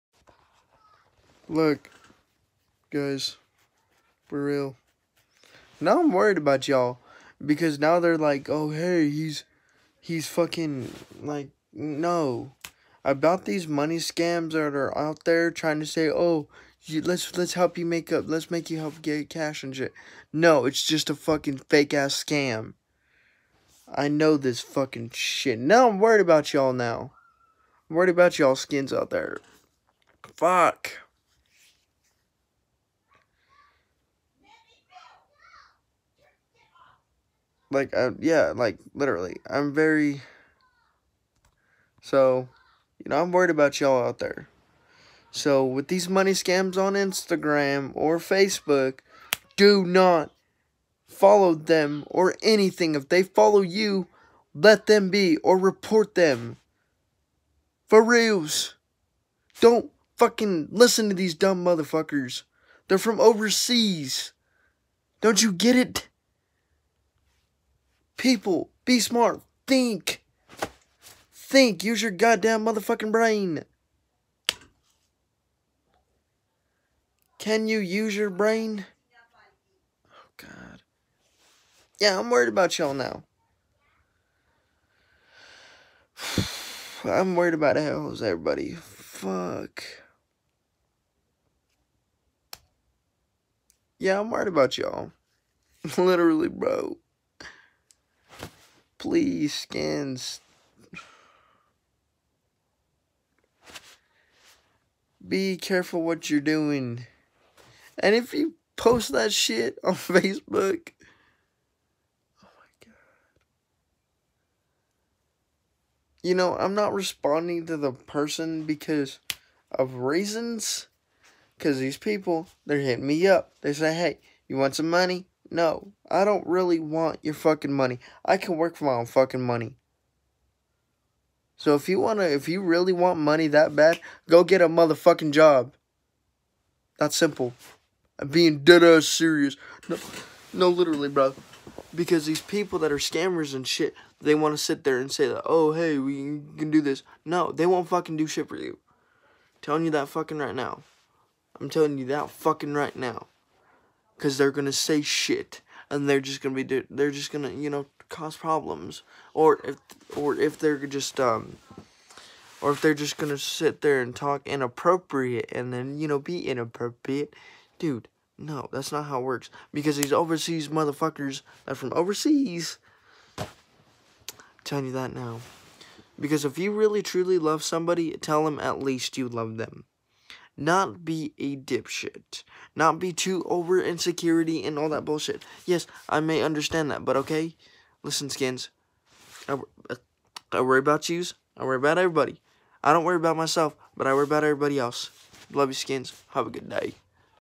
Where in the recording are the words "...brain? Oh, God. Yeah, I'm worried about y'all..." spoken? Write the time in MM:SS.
01:18.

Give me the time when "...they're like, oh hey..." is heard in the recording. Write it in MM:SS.
00:07.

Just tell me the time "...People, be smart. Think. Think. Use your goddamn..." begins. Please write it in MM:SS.
01:08.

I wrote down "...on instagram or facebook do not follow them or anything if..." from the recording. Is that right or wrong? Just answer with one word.
right.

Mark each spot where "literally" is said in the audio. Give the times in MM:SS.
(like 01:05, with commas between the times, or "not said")
00:38, 01:35, 02:20.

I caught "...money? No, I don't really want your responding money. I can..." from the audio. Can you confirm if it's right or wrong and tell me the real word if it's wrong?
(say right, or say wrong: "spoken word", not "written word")
wrong: "fucking", not "responding".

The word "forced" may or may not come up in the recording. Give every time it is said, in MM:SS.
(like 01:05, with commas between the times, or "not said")
not said.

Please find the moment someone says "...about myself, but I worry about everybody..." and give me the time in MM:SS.
03:13.